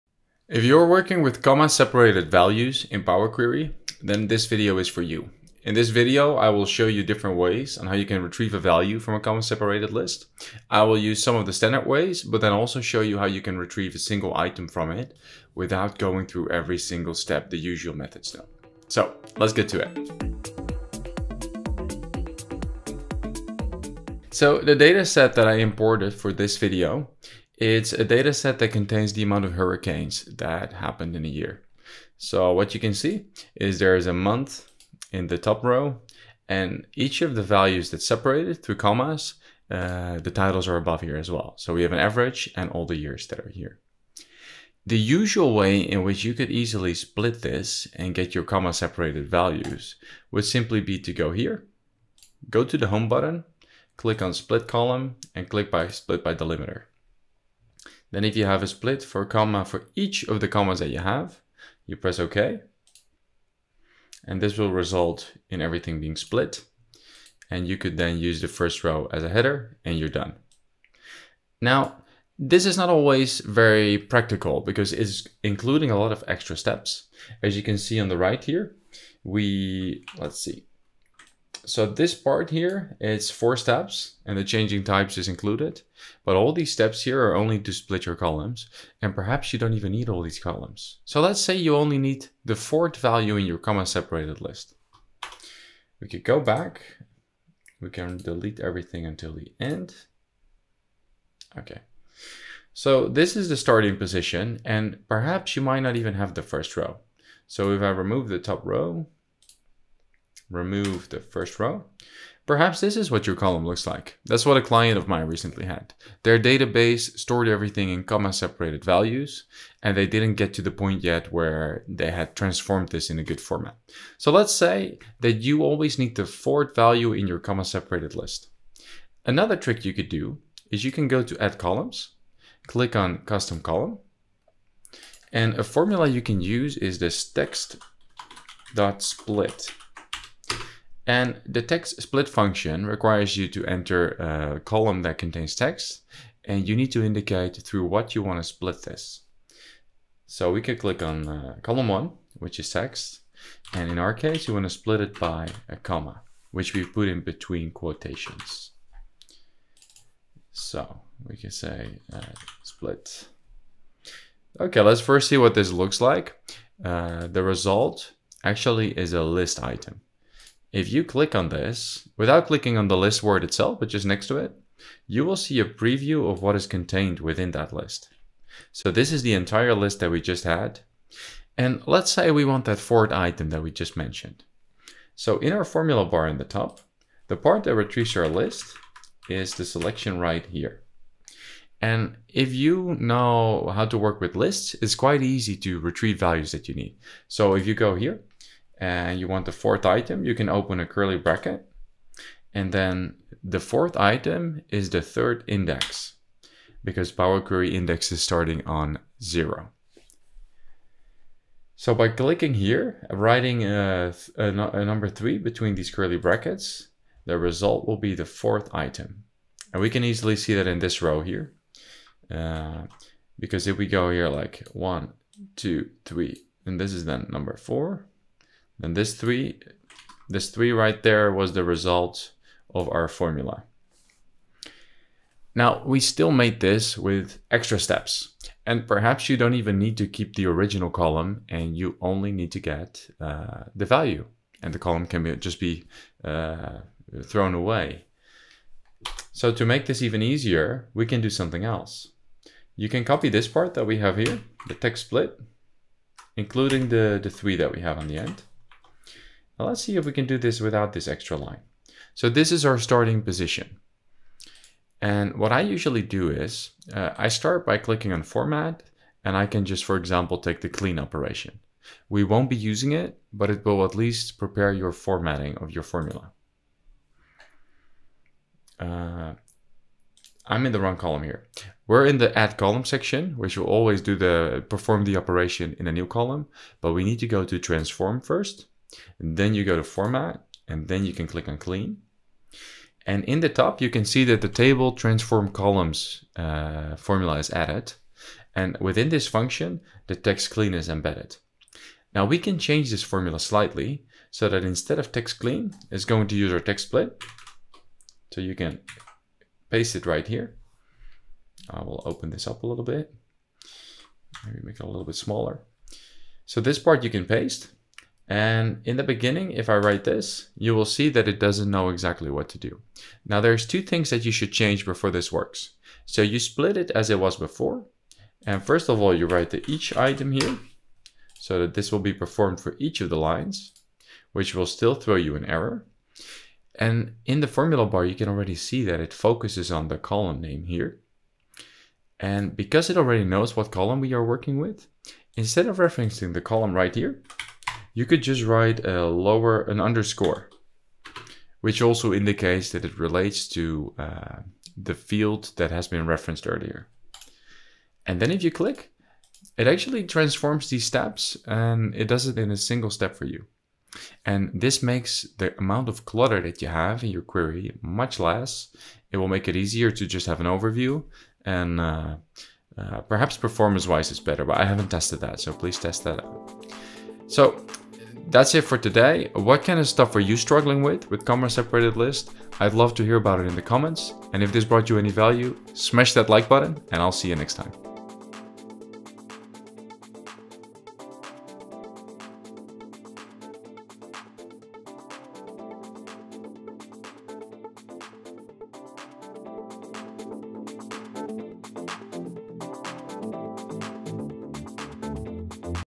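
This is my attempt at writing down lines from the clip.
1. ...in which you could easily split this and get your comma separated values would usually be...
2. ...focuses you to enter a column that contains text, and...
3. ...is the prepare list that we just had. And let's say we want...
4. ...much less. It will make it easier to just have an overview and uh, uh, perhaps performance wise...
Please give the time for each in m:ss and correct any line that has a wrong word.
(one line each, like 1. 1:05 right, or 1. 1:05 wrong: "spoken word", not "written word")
1. 0:45 wrong: "simply", not "usually"
2. 2:22 wrong: "requires", not "focuses"
3. 2:59 wrong: "entire", not "prepare"
4. 6:07 right.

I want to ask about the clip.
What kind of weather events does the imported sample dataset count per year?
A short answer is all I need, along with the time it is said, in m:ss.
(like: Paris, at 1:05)
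Hurricanes, at 0:29.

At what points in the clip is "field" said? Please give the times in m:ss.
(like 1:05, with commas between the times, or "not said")
5:54.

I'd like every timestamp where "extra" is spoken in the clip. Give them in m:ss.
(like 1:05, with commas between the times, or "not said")
1:16, 3:57, 4:21.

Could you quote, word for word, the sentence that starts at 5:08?
So you can paste it right here.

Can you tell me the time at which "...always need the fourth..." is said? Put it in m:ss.
2:05.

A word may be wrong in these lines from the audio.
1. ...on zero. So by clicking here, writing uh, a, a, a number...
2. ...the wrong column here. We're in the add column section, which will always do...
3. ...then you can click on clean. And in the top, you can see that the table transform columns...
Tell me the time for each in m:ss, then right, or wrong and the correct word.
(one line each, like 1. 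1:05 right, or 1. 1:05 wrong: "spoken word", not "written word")
1. 3:28 right
2. 4:40 right
3. 4:50 right.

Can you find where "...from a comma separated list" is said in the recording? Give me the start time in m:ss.
0:08.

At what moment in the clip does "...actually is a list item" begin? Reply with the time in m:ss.
2:48.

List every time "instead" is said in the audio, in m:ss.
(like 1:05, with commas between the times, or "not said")
5:04, 5:45.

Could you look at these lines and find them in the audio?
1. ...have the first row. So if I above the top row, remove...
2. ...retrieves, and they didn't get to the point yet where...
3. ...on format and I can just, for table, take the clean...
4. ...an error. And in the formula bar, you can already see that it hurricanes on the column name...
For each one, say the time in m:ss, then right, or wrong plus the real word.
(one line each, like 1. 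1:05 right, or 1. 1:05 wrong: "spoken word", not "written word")
1. 1:46 wrong: "remove", not "above"
2. 1:58 wrong: "values", not "retrieves"
3. 4:28 wrong: "example", not "table"
4. 5:35 wrong: "focuses", not "hurricanes".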